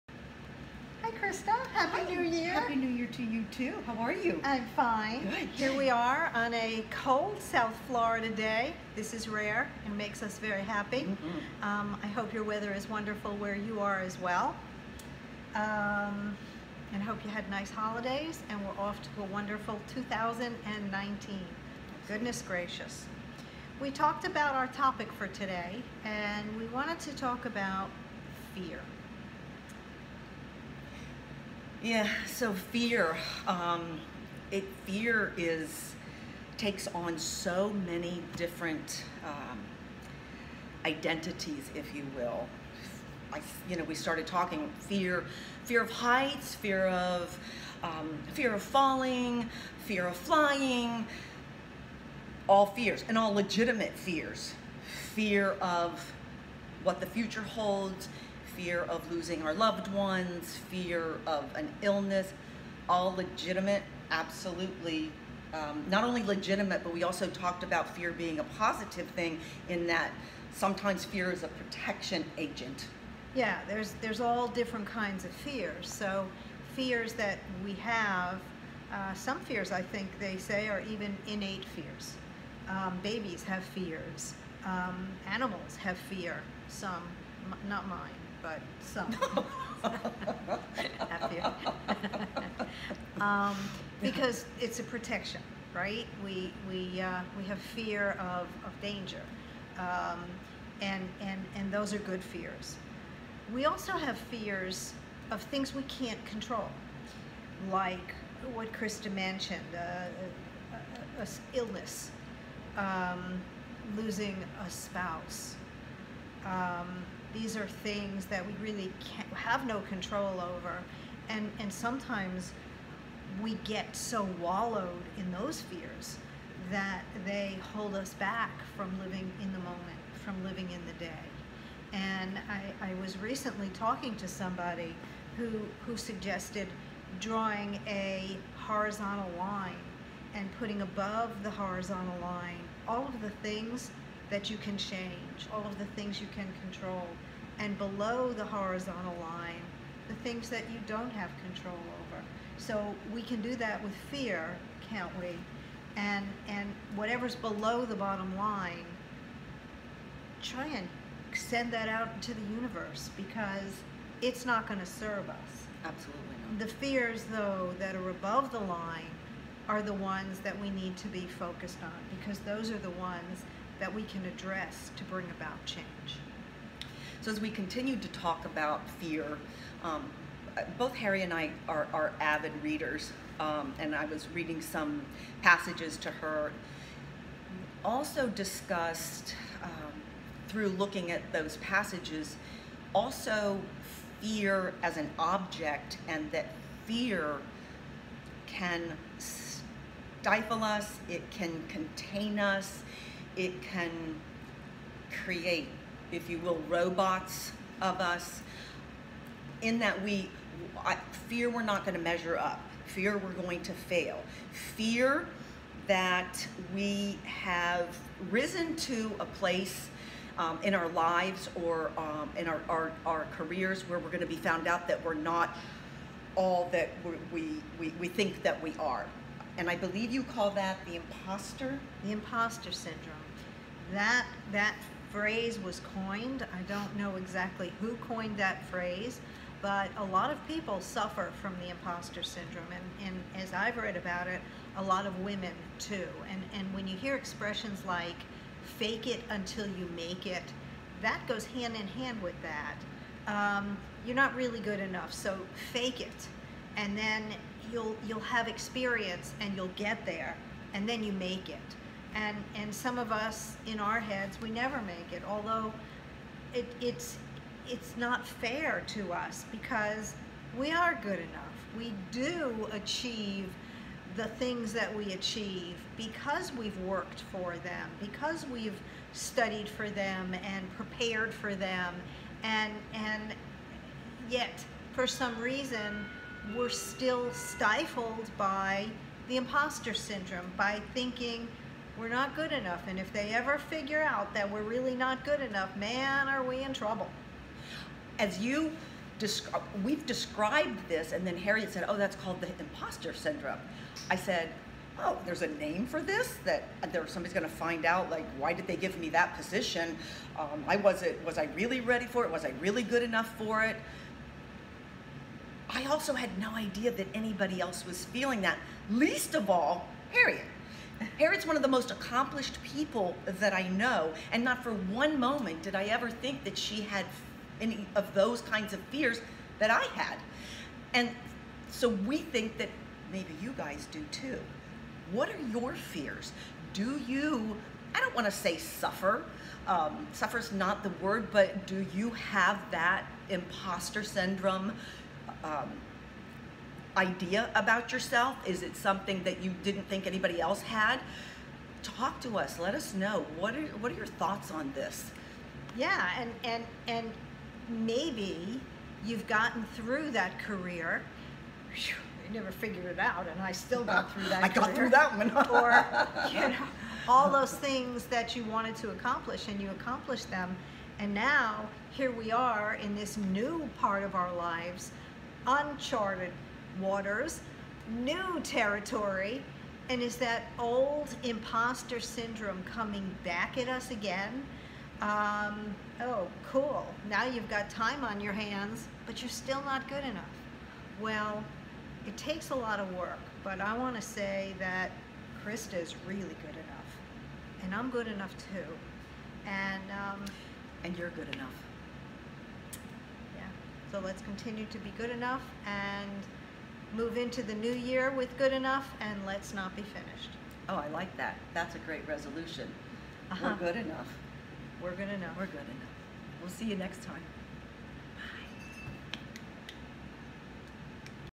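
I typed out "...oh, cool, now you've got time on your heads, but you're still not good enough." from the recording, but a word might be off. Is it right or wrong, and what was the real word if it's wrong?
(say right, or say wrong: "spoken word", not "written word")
wrong: "hands", not "heads".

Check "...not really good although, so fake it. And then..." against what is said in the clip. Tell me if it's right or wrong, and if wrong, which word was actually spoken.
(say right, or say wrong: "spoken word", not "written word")
wrong: "enough", not "although".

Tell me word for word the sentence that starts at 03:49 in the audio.
And I believe you call that the imposter?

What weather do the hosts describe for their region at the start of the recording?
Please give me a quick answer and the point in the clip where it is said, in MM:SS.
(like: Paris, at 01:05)
cold, at 00:06.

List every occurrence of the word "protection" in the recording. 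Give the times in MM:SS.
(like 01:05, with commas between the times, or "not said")
01:11, 01:34.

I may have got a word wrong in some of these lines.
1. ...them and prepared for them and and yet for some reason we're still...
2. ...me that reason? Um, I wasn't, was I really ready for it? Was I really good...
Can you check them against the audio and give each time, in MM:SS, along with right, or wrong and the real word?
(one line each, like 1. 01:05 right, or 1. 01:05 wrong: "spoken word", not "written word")
1. 04:39 right
2. 05:08 wrong: "position", not "reason".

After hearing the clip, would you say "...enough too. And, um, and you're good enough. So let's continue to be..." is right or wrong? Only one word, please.
right.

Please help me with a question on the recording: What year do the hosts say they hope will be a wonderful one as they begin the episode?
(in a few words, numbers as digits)
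2019.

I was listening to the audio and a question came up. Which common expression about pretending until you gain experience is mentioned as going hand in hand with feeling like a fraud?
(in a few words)
fake it until you make it.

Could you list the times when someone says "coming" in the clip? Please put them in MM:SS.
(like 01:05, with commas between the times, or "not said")
06:22.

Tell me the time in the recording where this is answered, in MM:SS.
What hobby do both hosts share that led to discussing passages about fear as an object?
03:02.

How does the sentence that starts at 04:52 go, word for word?
And if they ever figure out that we're really not good enough, man, are we in trouble.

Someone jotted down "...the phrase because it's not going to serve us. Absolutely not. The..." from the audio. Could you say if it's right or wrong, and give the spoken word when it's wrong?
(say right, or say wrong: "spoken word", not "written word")
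wrong: "universe", not "phrase".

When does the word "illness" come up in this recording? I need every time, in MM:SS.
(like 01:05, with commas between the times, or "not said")
01:01, 01:51.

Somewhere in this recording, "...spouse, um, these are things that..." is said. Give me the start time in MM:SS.
01:54.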